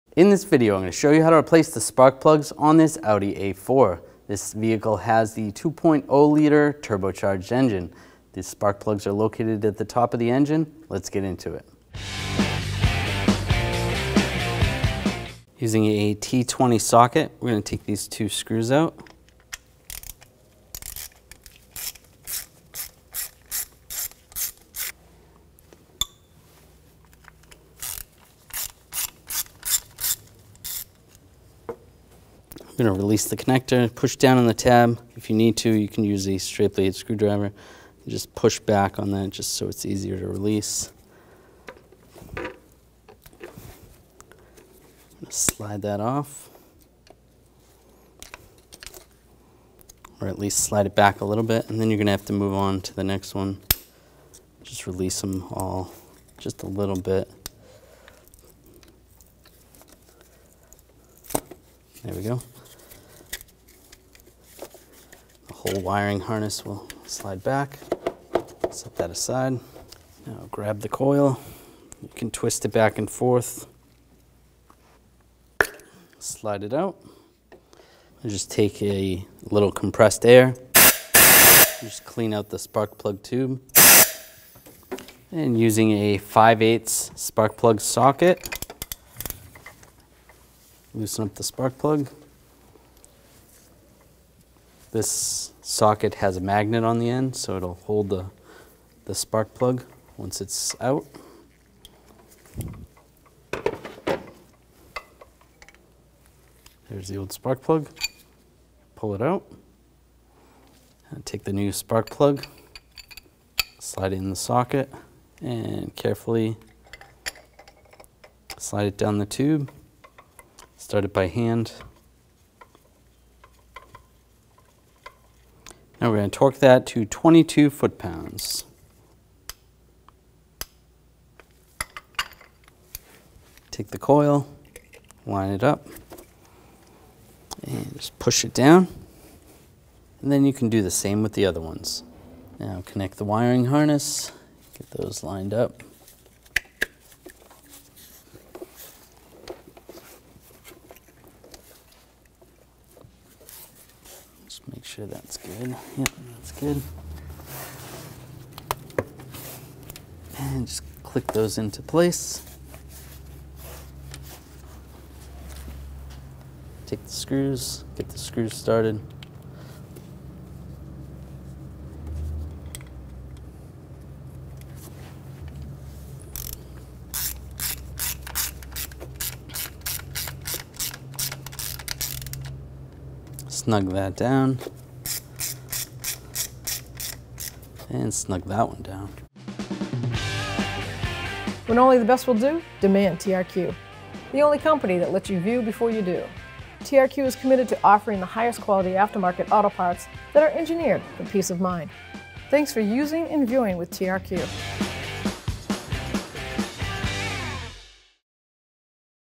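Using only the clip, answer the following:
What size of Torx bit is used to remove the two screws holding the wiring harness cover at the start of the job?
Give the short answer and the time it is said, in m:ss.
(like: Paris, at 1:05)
T20, at 0:16.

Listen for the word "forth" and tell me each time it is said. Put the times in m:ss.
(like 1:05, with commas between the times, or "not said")
1:13.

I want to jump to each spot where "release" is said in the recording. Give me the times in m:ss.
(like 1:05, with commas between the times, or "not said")
0:32, 0:40, 0:54.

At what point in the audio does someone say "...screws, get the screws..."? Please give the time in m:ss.
2:47.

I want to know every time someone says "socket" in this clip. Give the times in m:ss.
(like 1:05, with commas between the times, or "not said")
0:16, 1:27, 1:35, 1:54.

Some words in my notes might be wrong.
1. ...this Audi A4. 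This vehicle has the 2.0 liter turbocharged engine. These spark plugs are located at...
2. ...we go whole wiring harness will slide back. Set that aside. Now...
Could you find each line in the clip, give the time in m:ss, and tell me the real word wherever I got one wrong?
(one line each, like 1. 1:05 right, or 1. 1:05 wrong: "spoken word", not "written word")
1. 0:02 right
2. 1:02 right.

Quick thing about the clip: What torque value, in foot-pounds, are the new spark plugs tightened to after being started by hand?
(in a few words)
22 foot-pounds.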